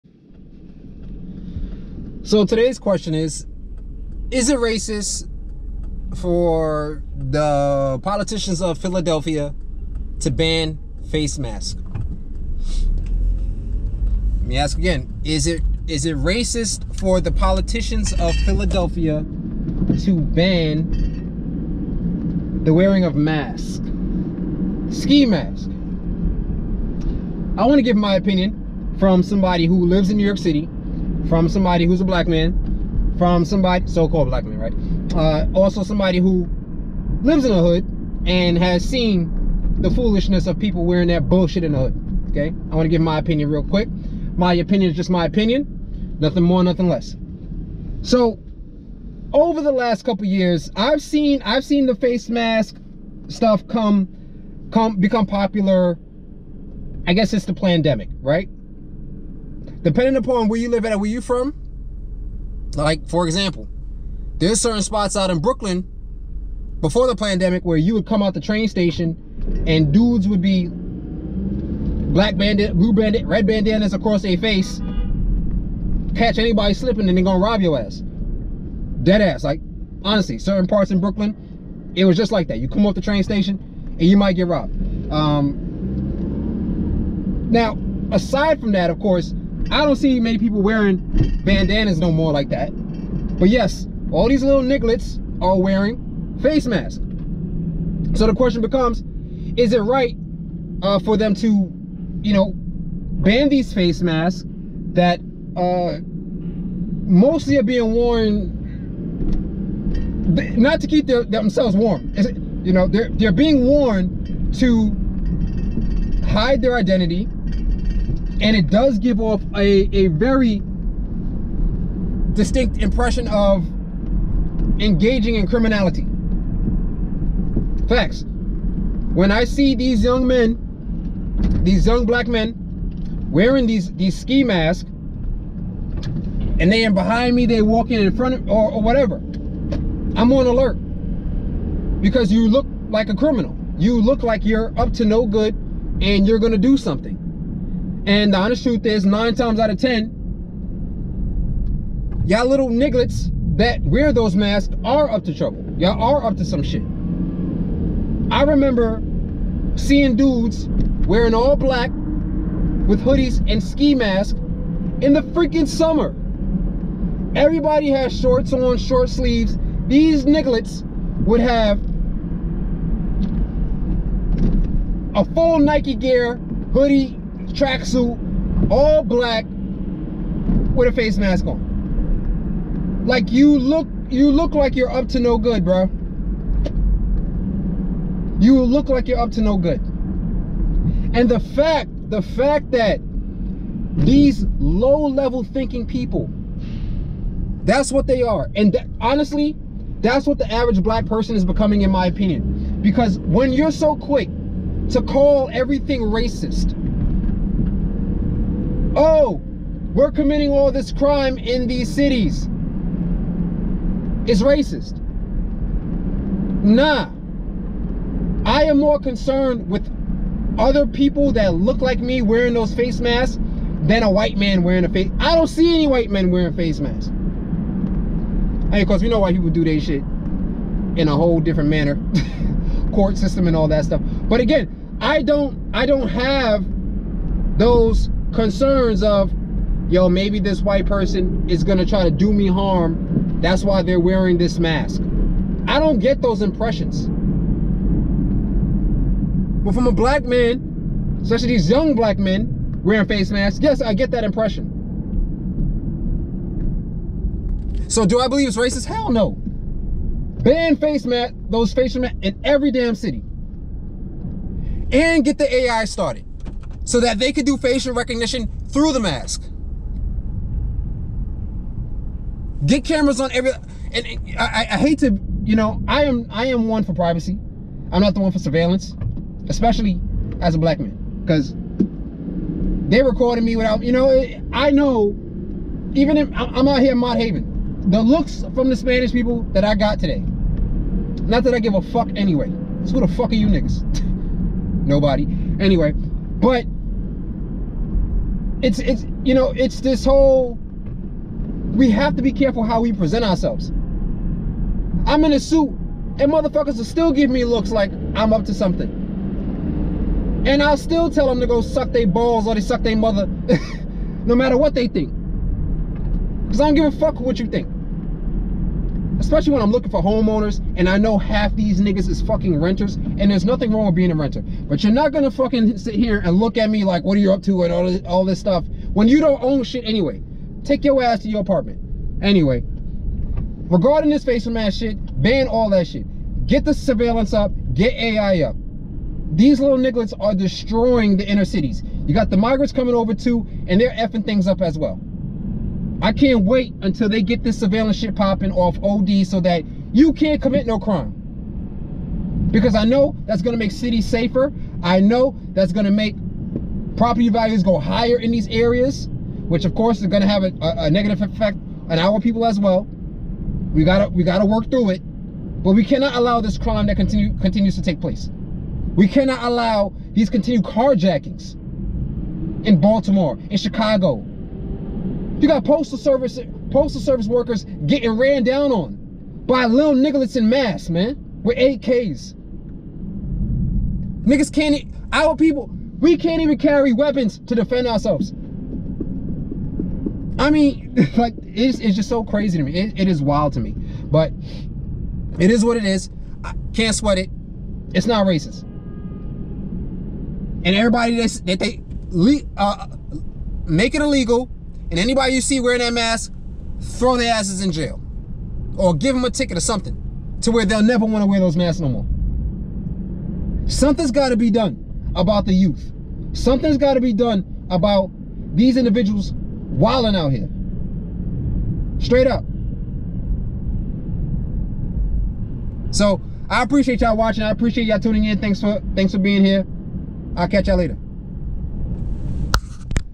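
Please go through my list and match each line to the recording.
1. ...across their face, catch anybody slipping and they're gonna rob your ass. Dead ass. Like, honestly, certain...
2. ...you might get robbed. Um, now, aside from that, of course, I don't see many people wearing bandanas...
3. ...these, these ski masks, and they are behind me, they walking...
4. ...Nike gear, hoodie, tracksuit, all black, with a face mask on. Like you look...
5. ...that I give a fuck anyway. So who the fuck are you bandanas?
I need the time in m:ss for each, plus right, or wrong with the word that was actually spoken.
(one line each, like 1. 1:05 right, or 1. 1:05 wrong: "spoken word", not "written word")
1. 1:13 right
2. 1:24 right
3. 2:13 right
4. 2:55 right
5. 4:51 wrong: "niggas", not "bandanas".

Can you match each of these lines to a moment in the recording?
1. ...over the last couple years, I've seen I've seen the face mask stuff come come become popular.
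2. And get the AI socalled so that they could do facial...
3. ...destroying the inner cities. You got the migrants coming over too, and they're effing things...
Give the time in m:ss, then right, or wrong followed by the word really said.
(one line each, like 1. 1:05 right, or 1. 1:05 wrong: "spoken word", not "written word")
1. 0:49 right
2. 4:24 wrong: "started", not "socalled"
3. 5:40 right.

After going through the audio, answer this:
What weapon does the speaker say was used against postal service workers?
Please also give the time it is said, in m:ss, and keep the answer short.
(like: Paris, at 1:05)
AKs, at 6:21.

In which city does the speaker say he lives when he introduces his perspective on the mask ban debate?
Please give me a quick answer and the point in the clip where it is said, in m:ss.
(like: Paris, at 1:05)
New York City, at 0:30.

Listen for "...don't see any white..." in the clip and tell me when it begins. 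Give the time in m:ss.
3:45.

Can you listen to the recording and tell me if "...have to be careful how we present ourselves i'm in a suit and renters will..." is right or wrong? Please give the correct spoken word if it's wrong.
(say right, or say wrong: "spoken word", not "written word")
wrong: "motherfuckers", not "renters".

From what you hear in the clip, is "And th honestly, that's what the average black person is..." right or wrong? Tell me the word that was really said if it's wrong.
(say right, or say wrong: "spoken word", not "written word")
right.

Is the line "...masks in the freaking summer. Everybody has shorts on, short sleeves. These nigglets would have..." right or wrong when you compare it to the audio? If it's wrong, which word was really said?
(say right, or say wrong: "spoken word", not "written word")
right.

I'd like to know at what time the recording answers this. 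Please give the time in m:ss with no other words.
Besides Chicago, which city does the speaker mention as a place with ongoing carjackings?
6:12.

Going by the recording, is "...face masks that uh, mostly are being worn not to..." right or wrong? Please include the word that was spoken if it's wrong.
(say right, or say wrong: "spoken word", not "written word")
right.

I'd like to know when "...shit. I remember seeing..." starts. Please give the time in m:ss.
2:36.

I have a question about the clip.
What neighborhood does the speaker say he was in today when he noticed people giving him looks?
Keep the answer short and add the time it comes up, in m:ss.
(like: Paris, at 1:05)
Mott Haven, at 4:46.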